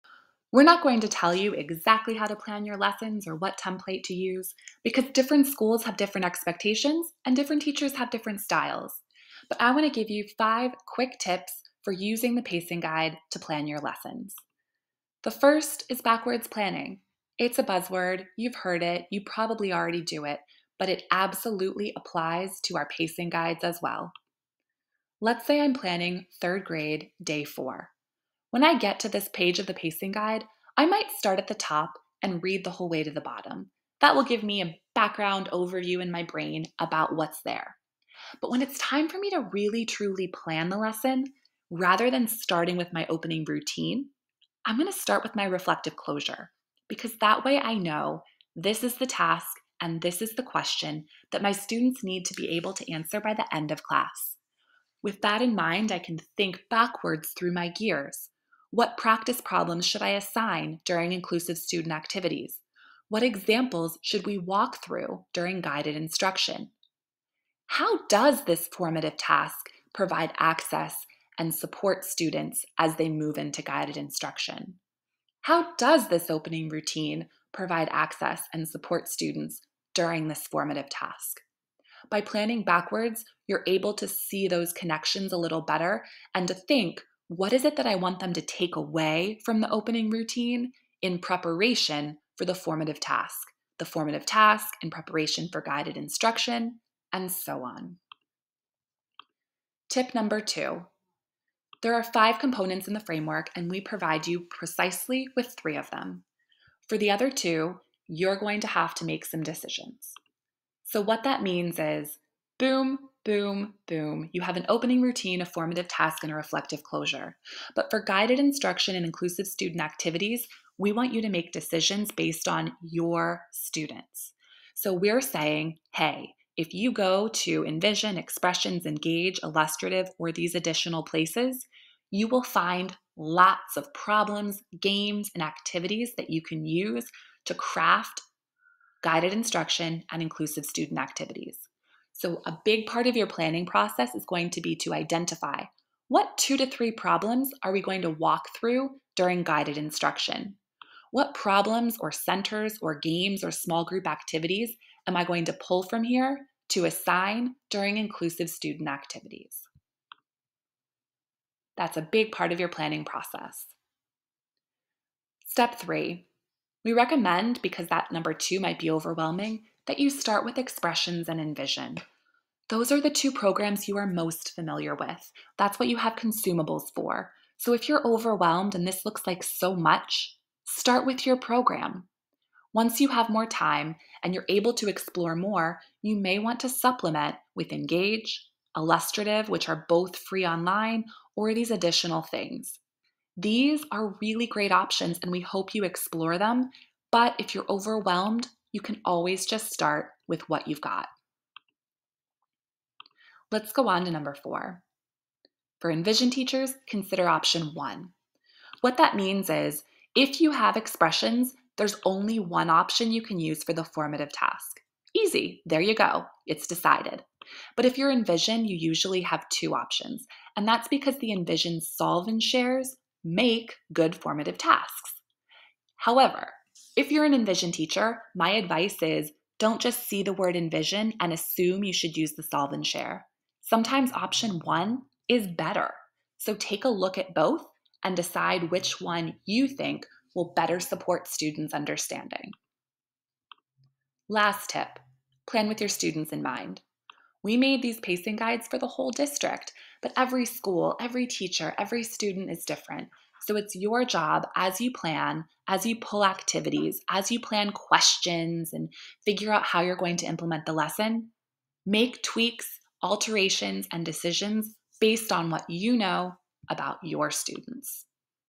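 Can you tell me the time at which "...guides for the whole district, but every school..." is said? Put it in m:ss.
4:08.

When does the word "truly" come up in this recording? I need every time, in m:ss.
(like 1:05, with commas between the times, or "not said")
0:39.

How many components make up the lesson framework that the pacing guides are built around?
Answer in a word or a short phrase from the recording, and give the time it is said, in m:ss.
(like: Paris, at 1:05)
5, at 1:42.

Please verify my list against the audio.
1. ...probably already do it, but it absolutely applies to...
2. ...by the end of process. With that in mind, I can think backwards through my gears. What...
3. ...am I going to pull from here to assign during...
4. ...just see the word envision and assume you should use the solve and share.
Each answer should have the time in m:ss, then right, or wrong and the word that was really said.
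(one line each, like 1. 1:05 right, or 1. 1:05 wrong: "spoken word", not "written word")
1. 0:19 right
2. 0:53 wrong: "class", not "process"
3. 2:35 right
4. 3:49 right.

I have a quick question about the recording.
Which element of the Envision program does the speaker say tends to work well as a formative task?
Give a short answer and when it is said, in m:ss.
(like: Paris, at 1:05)
solve and shares, at 3:41.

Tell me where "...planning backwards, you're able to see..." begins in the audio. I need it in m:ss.
1:22.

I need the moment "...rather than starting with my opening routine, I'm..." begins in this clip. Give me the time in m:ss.
0:41.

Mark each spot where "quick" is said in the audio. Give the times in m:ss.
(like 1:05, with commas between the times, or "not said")
0:10.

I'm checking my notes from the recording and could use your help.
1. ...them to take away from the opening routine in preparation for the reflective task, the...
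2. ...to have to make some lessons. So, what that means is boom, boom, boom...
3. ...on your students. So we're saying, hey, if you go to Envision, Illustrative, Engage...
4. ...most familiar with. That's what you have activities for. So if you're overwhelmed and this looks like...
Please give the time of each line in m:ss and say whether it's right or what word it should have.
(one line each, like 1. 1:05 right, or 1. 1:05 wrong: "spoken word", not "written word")
1. 1:28 wrong: "formative", not "reflective"
2. 1:48 wrong: "decisions", not "lessons"
3. 2:02 wrong: "Expressions", not "Illustrative"
4. 2:54 wrong: "consumables", not "activities".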